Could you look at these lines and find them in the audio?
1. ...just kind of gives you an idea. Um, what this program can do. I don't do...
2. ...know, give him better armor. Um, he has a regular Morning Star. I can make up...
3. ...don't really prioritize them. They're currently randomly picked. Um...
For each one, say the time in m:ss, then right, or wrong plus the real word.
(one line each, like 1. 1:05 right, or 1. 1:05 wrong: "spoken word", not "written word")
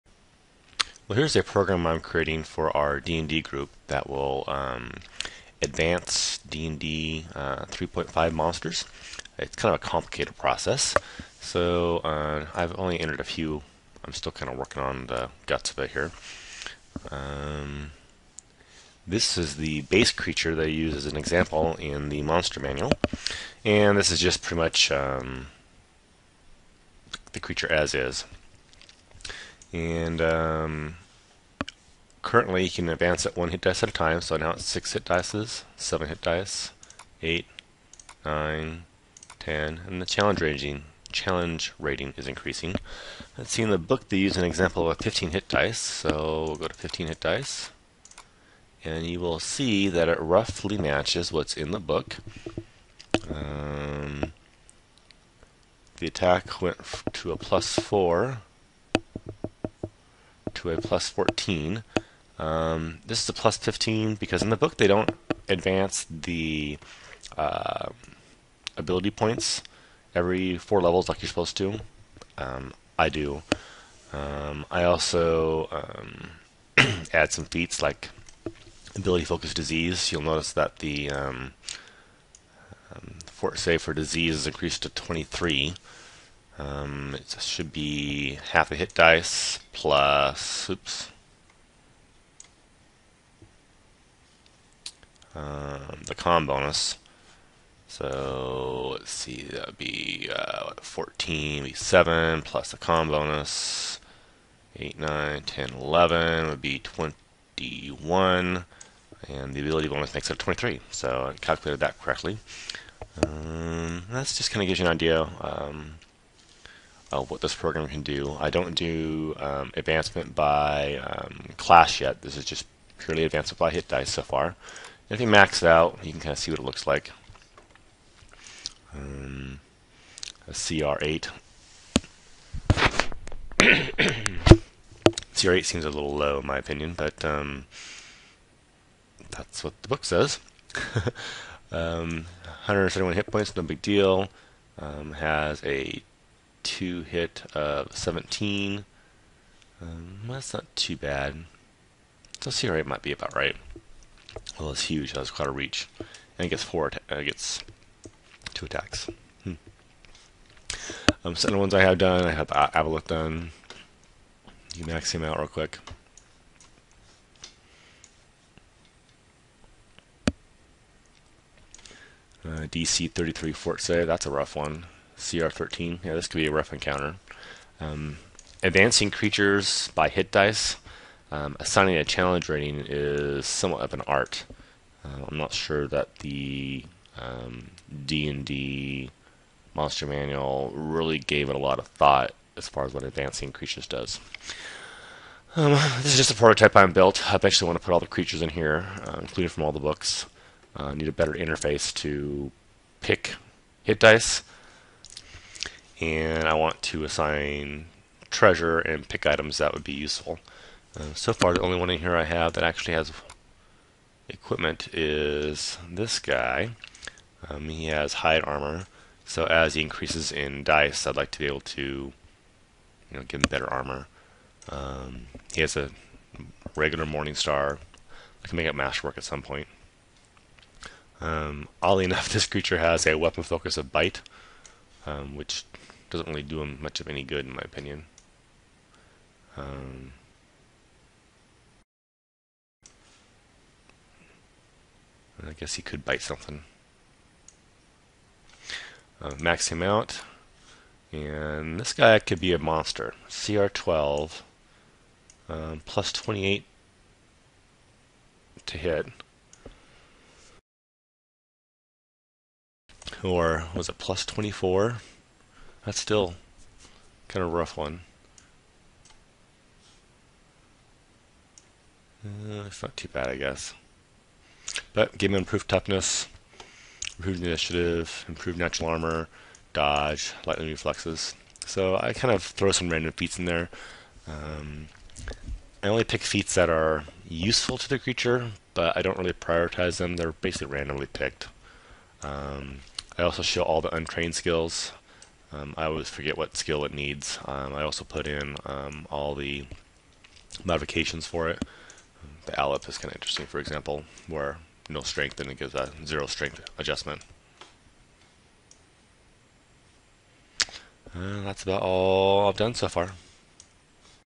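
1. 1:54 right
2. 3:43 right
3. 4:49 wrong: "basically", not "currently".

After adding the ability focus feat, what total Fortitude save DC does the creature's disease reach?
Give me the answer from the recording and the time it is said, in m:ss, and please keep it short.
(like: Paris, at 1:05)
23, at 1:24.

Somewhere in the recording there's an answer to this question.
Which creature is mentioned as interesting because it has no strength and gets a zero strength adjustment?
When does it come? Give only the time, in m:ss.
5:02.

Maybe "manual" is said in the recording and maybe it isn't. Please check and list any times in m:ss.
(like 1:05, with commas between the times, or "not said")
0:22, 3:10.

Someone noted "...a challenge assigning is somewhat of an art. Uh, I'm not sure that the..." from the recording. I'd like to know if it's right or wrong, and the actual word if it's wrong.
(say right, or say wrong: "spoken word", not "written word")
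wrong: "rating", not "assigning".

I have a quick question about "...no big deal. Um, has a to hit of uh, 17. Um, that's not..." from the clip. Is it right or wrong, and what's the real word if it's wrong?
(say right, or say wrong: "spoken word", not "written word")
right.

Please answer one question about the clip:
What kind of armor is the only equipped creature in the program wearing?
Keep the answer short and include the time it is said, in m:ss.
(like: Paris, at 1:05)
Hide armor, at 3:38.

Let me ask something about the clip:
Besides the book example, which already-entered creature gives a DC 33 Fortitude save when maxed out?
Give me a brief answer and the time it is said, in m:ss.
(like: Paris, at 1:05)
Aboleth, at 2:42.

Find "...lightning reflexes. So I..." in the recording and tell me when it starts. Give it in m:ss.
4:40.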